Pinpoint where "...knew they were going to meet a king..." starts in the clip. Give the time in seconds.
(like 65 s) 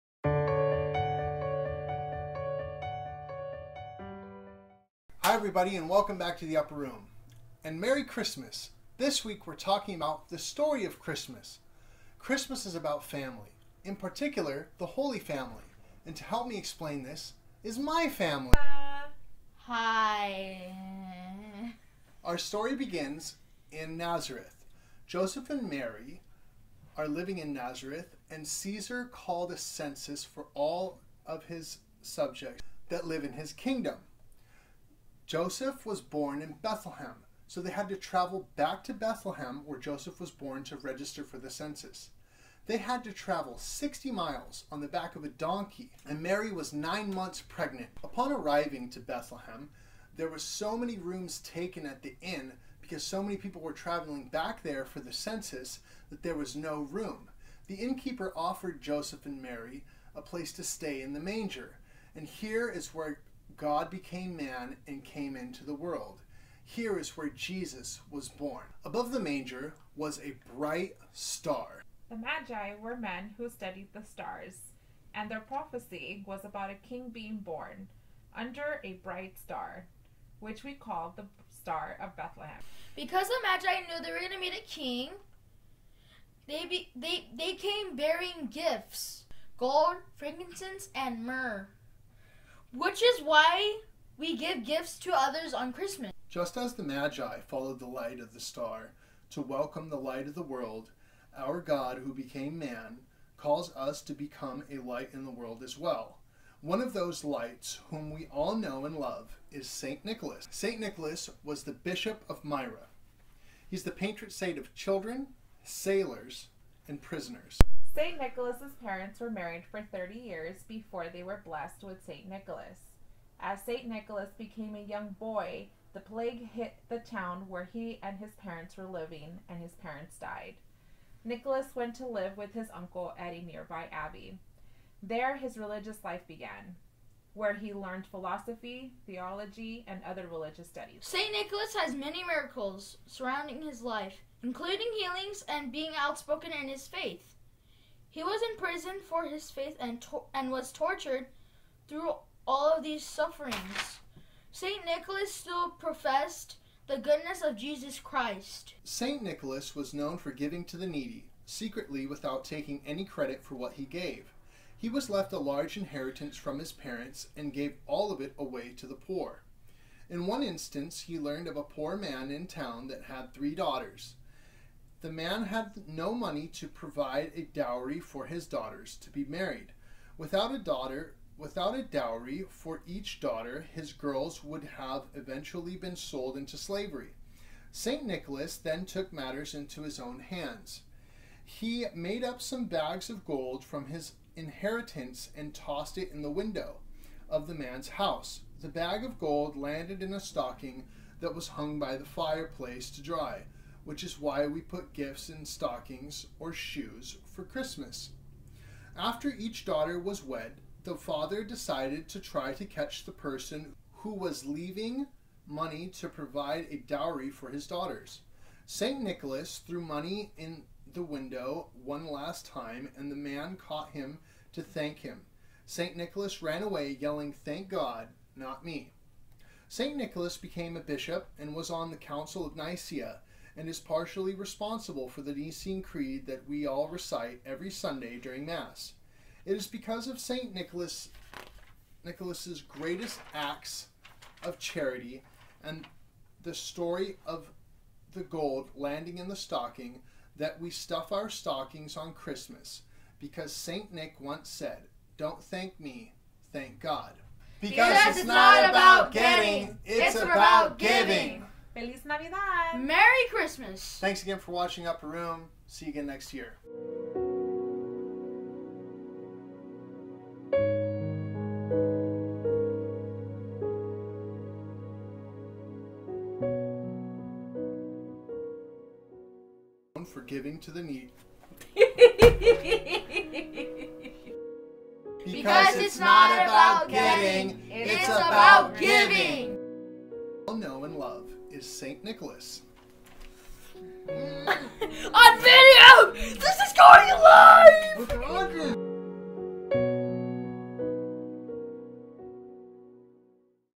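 83 s.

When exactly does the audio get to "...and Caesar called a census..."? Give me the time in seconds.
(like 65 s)
28 s.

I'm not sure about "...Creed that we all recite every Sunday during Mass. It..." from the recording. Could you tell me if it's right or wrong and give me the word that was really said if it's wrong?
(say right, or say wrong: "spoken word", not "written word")
right.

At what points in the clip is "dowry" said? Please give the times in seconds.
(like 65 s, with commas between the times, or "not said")
177 s, 181 s, 216 s.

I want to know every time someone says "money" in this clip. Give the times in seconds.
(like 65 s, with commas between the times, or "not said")
176 s, 215 s, 219 s.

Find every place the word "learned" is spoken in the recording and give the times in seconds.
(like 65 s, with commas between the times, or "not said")
137 s, 171 s.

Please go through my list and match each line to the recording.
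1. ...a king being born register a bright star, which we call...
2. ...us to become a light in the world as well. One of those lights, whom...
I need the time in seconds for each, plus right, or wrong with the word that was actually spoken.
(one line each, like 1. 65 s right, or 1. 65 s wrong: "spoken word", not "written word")
1. 76 s wrong: "under", not "register"
2. 103 s right.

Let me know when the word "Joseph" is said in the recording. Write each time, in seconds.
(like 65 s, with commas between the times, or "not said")
25 s, 35 s, 39 s, 58 s.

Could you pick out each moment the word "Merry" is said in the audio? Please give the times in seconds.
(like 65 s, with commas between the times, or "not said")
7 s, 262 s.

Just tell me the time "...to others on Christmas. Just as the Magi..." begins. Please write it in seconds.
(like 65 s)
94 s.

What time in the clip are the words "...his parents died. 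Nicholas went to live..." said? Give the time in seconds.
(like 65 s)
129 s.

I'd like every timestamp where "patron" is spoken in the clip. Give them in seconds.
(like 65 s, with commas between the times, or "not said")
113 s.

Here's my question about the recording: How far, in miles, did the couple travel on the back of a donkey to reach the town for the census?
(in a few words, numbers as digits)
60 miles.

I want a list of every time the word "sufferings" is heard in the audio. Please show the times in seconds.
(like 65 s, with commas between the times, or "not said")
153 s.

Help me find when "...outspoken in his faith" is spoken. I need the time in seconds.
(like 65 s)
145 s.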